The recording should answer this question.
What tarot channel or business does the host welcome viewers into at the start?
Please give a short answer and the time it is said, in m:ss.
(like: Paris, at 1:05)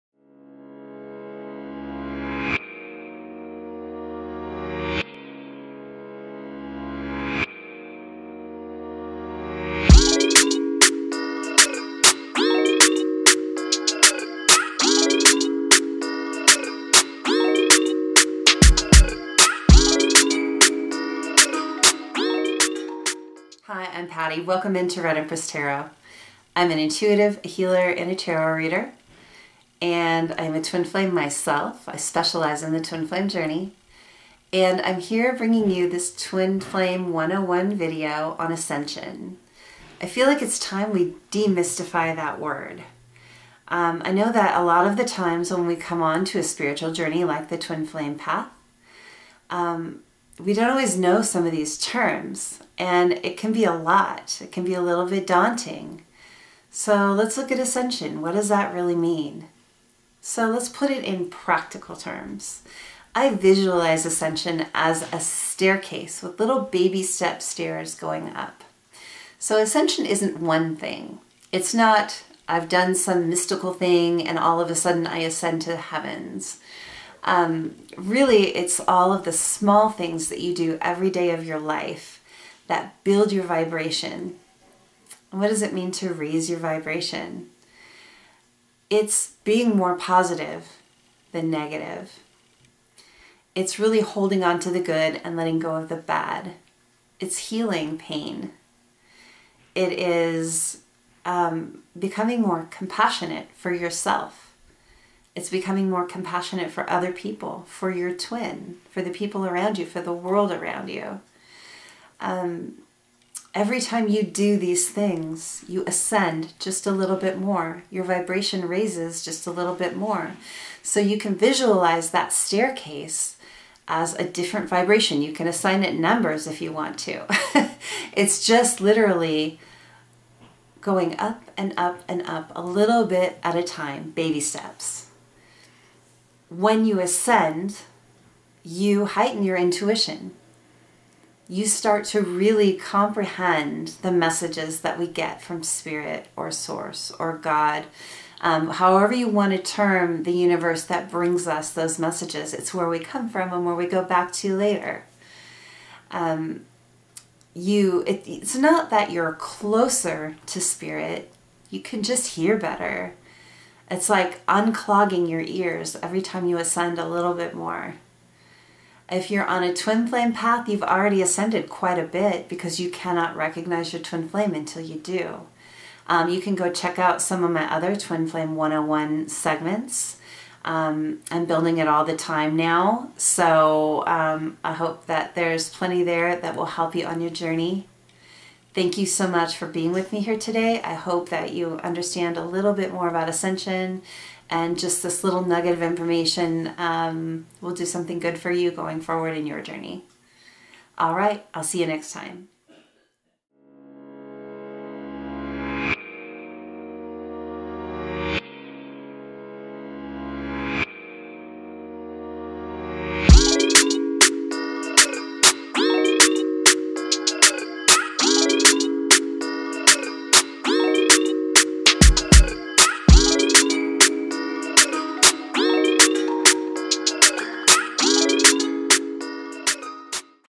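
Red Empress Tarot, at 0:25.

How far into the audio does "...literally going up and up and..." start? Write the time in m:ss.
2:08.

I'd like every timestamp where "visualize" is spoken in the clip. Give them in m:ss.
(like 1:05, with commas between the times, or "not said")
1:03, 2:01.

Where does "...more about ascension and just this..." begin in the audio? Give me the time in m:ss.
3:12.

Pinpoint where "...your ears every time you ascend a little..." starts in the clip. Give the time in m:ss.
2:45.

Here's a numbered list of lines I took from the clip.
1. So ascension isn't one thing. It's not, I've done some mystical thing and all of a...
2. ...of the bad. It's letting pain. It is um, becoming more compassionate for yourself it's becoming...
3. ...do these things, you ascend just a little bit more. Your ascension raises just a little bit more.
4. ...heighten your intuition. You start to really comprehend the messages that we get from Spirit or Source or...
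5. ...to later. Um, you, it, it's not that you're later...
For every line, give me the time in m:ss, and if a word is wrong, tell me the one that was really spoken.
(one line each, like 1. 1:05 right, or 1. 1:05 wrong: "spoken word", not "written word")
1. 1:09 right
2. 1:35 wrong: "healing", not "letting"
3. 1:54 wrong: "vibration", not "ascension"
4. 2:19 right
5. 2:34 wrong: "closer", not "later".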